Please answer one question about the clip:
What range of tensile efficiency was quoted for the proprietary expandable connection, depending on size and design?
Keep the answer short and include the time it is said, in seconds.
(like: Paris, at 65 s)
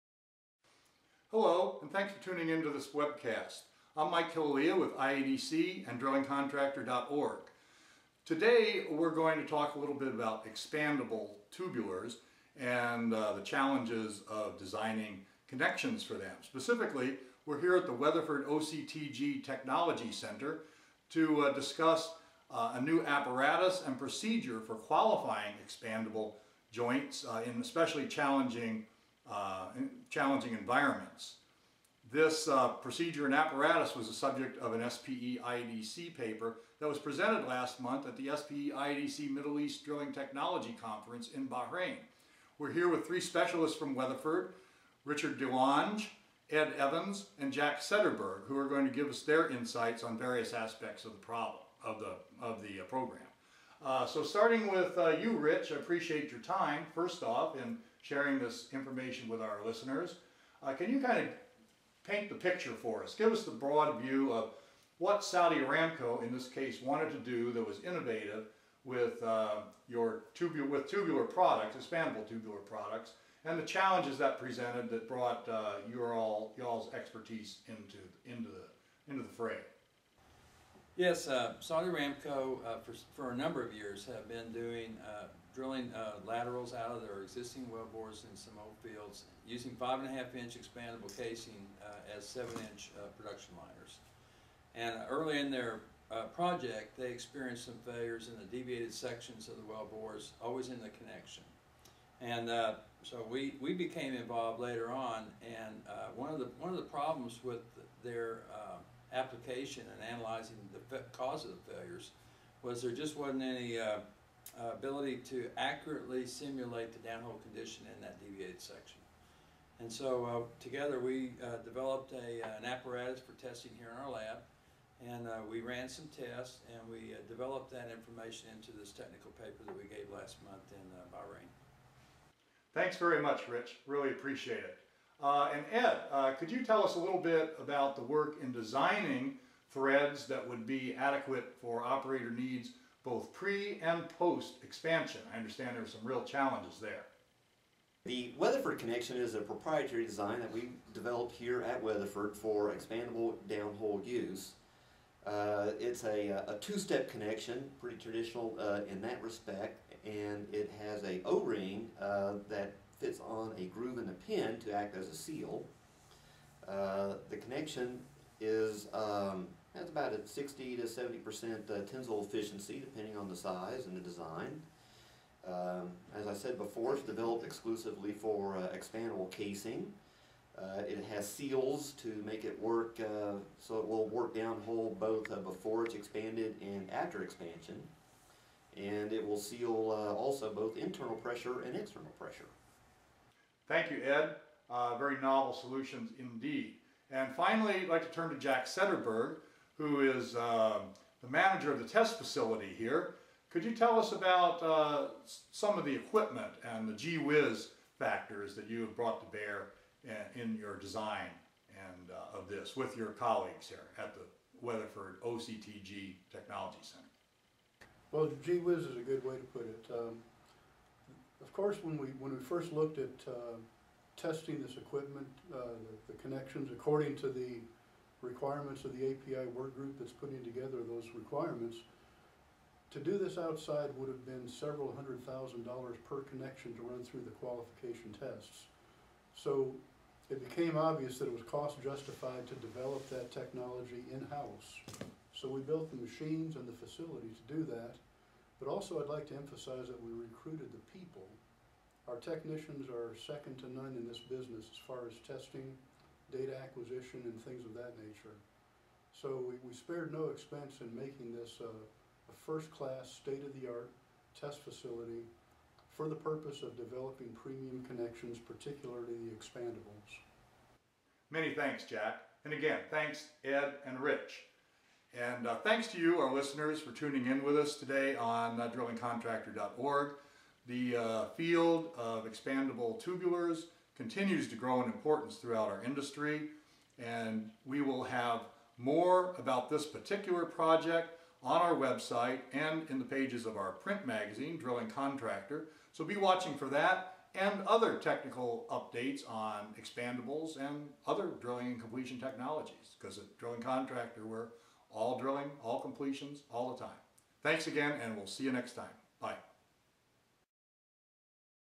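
60 to 70%, at 170 s.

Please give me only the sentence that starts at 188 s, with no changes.
And it will seal uh, also both internal pressure and external pressure.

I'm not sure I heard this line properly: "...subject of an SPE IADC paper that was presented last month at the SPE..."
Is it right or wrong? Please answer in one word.
right.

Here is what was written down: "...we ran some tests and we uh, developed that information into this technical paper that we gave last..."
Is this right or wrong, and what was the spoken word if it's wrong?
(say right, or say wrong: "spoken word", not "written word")
right.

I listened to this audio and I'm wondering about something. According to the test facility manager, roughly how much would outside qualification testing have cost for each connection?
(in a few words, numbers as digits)
several hundred thousand dollars.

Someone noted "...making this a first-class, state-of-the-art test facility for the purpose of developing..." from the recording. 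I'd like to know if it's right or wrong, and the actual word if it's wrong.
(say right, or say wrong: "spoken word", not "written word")
right.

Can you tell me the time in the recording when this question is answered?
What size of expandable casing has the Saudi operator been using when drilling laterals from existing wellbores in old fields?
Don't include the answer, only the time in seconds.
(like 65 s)
89 s.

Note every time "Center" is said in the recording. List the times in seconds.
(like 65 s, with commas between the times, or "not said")
20 s, 216 s.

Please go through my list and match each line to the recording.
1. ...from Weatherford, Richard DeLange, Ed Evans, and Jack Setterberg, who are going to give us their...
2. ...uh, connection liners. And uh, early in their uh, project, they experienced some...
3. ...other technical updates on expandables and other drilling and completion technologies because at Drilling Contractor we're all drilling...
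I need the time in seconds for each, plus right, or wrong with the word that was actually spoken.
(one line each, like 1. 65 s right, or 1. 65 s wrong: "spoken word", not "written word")
1. 43 s right
2. 92 s wrong: "production", not "connection"
3. 297 s right.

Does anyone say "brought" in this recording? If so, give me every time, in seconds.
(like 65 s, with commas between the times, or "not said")
75 s, 208 s.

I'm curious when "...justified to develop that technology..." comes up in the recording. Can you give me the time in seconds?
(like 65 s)
241 s.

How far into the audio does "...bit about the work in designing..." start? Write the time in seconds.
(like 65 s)
137 s.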